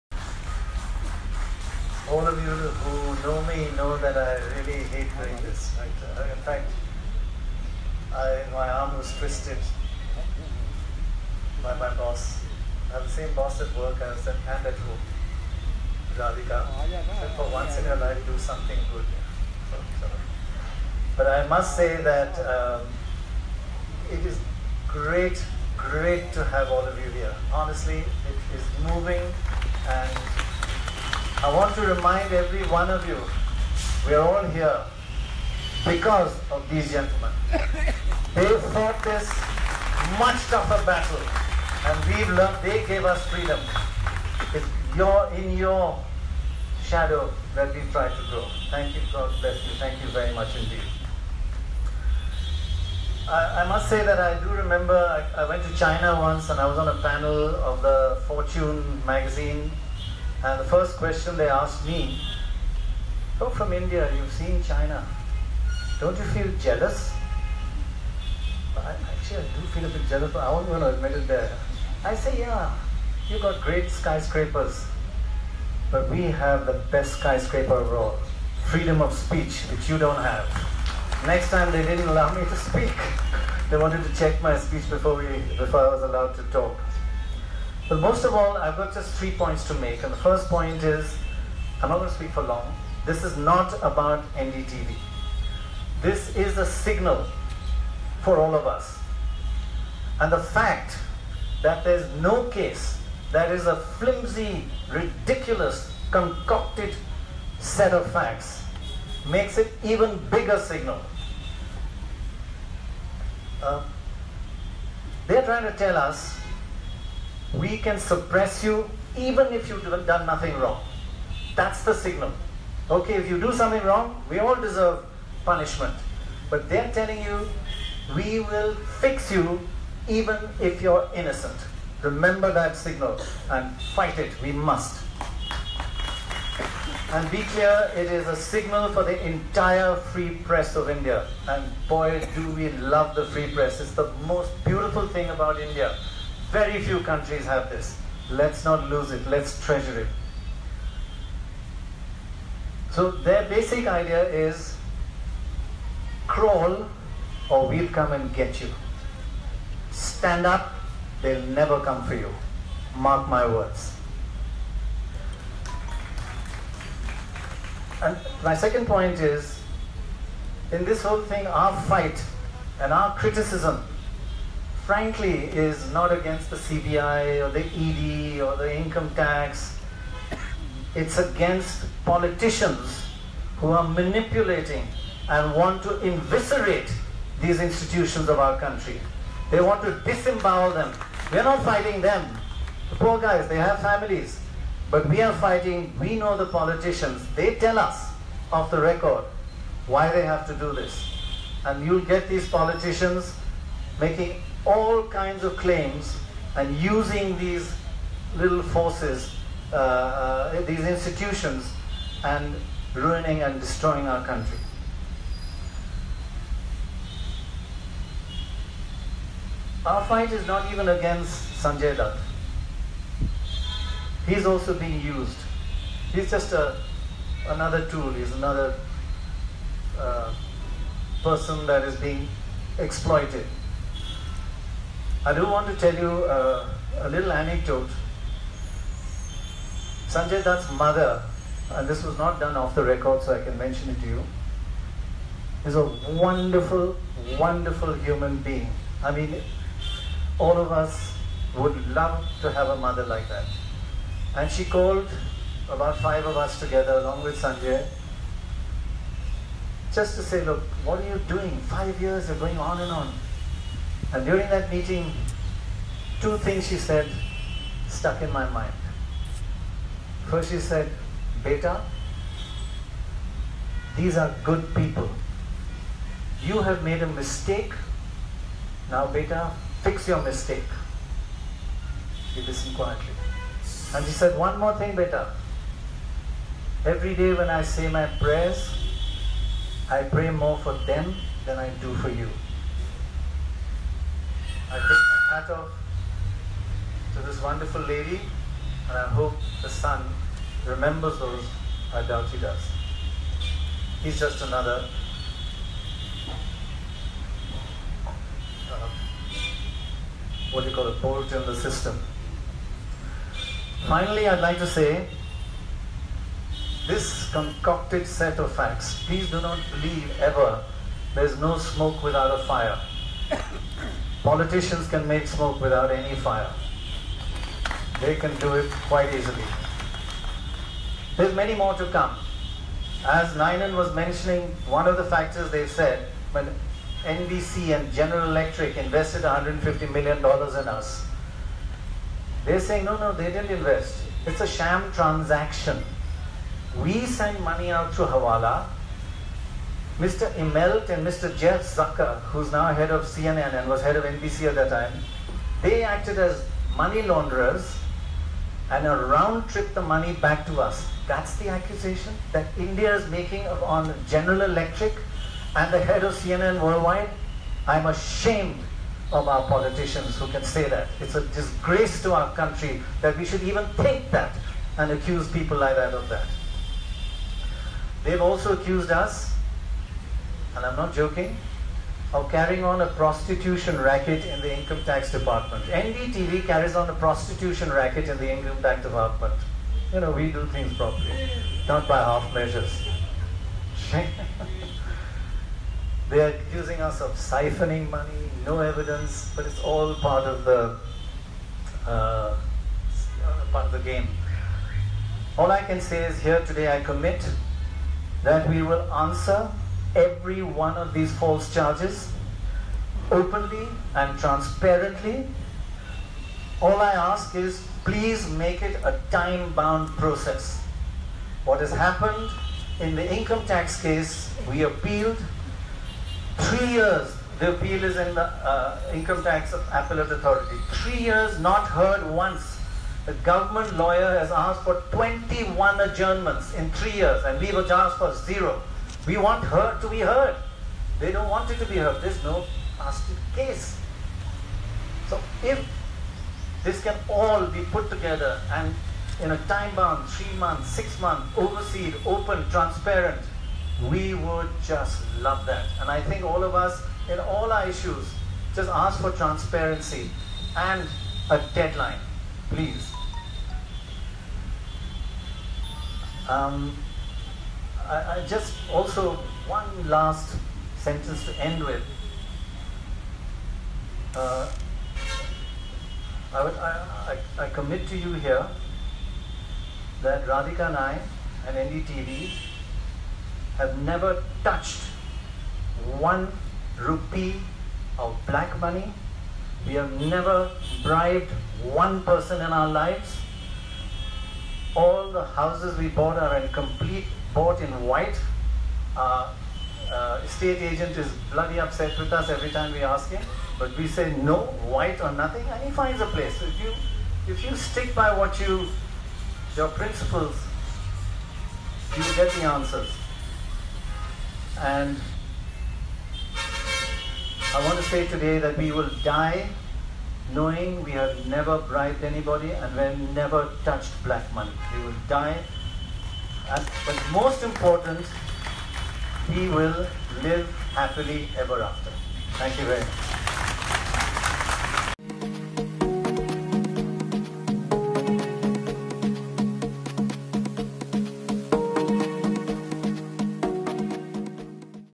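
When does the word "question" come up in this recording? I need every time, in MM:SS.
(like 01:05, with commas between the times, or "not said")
01:00.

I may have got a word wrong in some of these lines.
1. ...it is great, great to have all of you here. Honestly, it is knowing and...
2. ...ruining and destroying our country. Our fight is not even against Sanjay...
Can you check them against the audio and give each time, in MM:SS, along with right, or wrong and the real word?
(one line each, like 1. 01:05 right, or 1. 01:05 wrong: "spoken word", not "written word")
1. 00:24 wrong: "moving", not "knowing"
2. 03:32 right.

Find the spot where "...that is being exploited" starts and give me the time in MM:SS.
03:51.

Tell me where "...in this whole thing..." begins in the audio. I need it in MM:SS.
02:50.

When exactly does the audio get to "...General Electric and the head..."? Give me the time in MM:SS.
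06:04.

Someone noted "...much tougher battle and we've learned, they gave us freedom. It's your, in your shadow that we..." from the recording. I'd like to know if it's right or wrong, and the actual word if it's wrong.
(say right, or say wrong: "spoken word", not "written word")
right.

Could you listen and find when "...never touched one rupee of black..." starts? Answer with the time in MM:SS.
08:03.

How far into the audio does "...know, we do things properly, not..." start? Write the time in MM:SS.
06:30.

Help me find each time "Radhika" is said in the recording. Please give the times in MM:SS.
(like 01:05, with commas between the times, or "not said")
00:16, 08:00.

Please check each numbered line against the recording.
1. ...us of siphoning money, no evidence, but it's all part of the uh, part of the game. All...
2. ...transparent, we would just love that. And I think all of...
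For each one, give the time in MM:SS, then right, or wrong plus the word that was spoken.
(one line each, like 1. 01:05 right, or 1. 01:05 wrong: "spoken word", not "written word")
1. 06:36 right
2. 07:32 right.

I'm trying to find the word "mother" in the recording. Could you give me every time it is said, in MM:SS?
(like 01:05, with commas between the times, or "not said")
04:00, 04:12.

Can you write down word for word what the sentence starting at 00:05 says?
Uh, in fact, I, my arm was twisted by my boss.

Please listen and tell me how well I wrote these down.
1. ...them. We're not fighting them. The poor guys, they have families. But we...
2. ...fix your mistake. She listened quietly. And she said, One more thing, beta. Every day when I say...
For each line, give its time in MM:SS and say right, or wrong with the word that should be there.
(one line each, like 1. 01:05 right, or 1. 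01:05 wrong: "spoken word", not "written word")
1. 03:10 right
2. 04:39 right.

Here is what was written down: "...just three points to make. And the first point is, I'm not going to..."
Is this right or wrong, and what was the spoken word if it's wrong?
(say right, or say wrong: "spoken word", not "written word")
right.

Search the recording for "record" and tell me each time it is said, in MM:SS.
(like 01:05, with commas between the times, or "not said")
03:18, 04:02.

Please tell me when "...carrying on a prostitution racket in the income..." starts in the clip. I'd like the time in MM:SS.
06:22.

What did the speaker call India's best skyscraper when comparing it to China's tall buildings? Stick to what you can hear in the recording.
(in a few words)
freedom of speech.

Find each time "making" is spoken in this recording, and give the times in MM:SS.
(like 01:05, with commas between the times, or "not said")
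03:23, 06:03.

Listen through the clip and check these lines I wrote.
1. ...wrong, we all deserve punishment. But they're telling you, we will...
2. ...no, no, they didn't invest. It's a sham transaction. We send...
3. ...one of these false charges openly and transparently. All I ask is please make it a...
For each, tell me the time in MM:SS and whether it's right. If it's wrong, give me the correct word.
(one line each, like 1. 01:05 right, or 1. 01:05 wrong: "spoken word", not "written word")
1. 02:03 right
2. 05:42 right
3. 06:50 right.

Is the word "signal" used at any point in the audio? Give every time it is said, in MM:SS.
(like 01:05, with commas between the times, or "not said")
01:36, 01:50, 02:01, 02:12, 02:18.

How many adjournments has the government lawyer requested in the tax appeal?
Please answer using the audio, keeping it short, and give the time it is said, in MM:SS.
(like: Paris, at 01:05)
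21, at 07:14.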